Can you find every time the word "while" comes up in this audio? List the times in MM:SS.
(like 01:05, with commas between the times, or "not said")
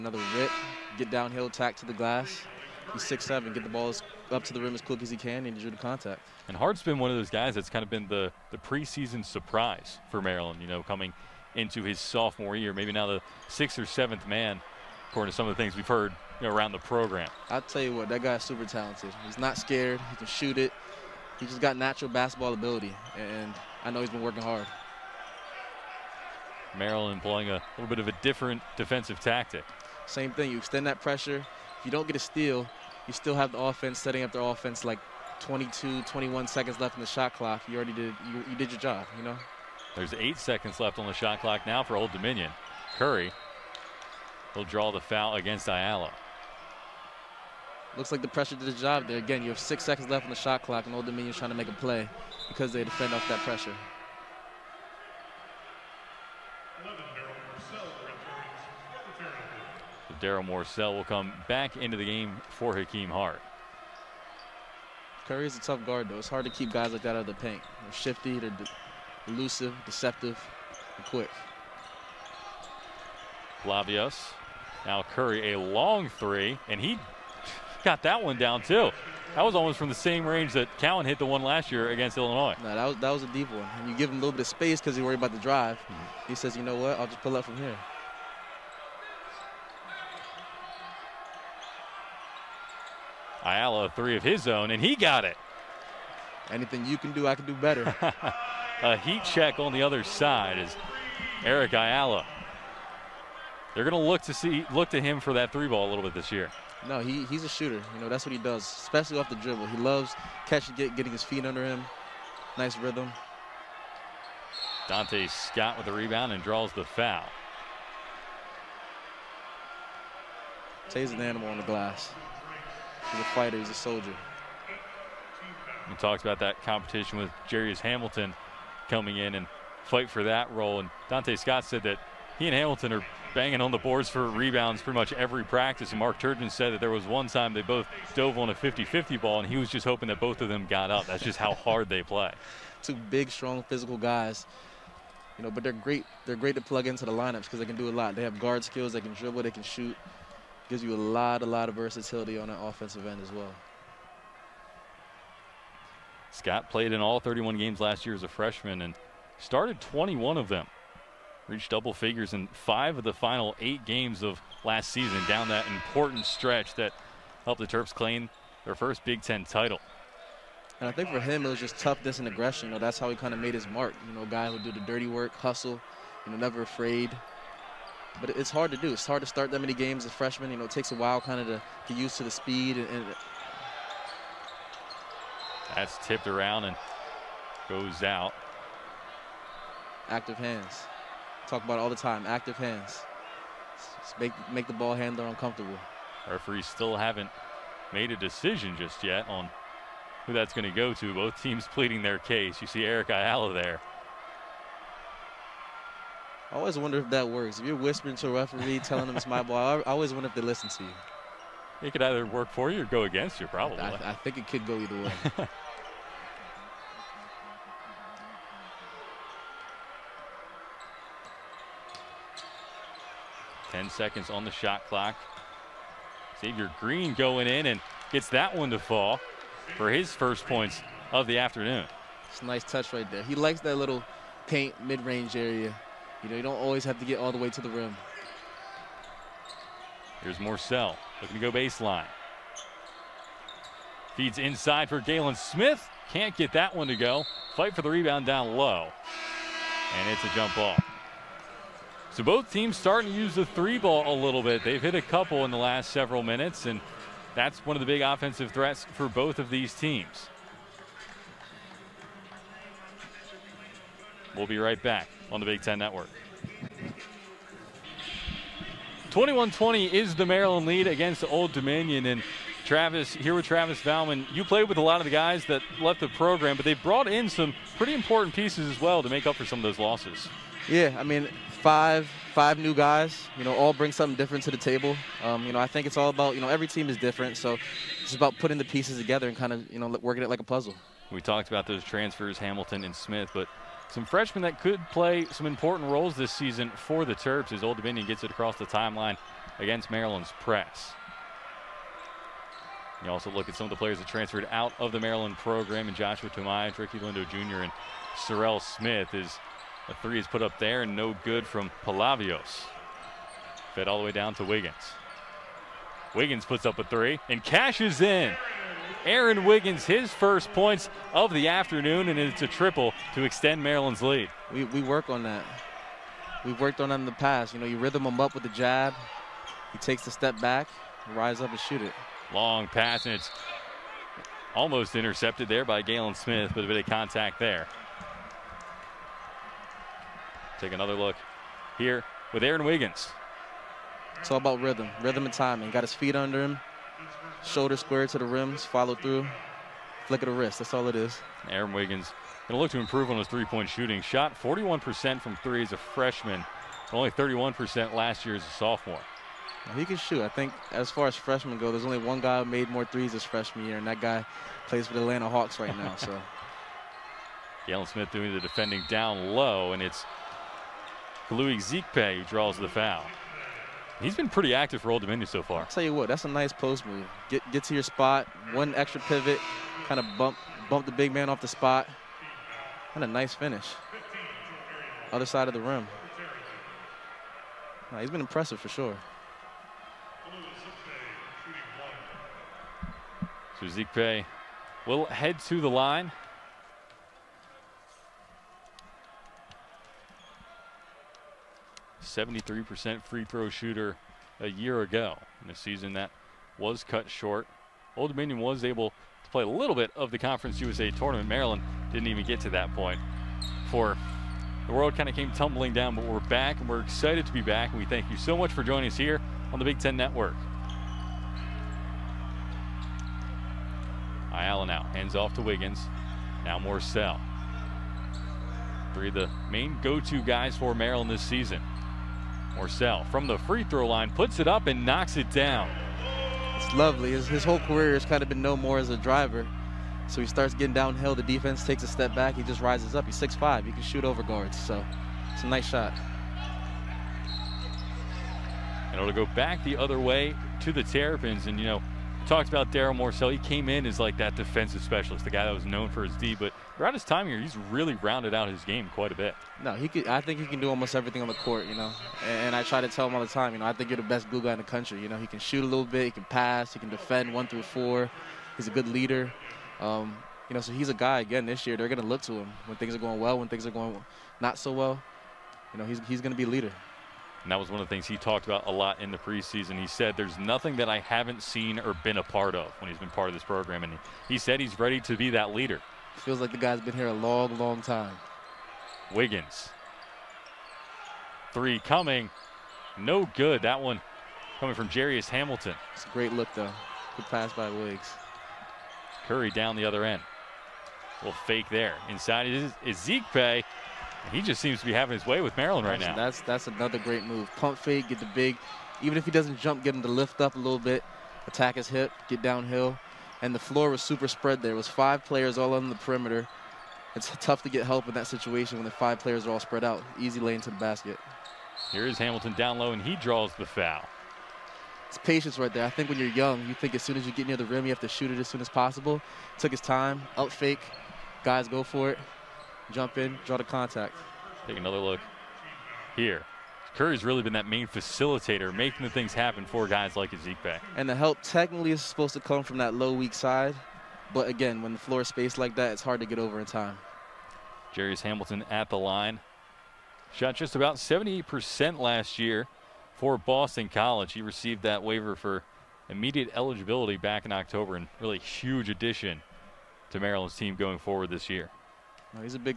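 03:00.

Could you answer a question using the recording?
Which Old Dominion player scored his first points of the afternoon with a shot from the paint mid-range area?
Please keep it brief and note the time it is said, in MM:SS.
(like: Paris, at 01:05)
Xavier Green, at 03:46.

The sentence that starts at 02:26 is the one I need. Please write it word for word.
They're great to plug into the lineups because they can do a lot.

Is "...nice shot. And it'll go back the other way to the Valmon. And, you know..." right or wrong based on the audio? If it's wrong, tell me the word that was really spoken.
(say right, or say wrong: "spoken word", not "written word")
wrong: "Terrapins", not "Valmon".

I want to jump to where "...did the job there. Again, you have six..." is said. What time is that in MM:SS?
00:48.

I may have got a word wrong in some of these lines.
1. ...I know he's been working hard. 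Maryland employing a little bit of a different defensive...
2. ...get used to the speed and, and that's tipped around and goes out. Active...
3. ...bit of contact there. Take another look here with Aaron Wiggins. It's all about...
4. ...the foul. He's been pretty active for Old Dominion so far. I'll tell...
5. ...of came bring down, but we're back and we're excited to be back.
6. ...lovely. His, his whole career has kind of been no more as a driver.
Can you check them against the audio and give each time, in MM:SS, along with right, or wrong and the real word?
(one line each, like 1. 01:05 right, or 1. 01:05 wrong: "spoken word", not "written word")
1. 00:23 right
2. 03:01 right
3. 05:36 right
4. 06:12 right
5. 06:55 wrong: "tumbling", not "bring"
6. 07:16 right.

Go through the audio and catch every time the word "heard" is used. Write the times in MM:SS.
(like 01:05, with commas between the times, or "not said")
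00:15.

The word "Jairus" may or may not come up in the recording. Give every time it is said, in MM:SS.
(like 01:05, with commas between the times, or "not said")
02:07, 08:14, 09:07.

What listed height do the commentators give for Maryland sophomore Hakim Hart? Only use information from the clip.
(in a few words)
6'7.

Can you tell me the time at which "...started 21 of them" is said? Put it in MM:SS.
02:39.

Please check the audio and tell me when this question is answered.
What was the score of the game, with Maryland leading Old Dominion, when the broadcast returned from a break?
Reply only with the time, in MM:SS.
04:29.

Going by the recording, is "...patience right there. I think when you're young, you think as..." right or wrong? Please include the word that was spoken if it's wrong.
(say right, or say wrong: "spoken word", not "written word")
right.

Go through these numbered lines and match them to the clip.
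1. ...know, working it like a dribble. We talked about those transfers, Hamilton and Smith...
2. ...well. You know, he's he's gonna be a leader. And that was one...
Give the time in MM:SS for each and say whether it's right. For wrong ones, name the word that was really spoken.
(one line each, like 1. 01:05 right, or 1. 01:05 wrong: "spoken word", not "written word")
1. 04:49 wrong: "puzzle", not "dribble"
2. 07:54 right.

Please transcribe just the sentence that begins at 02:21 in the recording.
That's just how hard they play.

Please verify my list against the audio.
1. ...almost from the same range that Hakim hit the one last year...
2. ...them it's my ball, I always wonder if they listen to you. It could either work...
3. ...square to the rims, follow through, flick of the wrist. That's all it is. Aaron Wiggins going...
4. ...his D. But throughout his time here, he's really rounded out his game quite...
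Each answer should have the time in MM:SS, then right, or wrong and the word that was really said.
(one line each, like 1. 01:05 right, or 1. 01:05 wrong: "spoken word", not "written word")
1. 01:19 wrong: "Cowan", not "Hakim"
2. 03:29 right
3. 05:47 right
4. 07:36 right.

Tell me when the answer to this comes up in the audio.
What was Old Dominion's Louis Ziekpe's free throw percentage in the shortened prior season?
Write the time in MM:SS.
06:42.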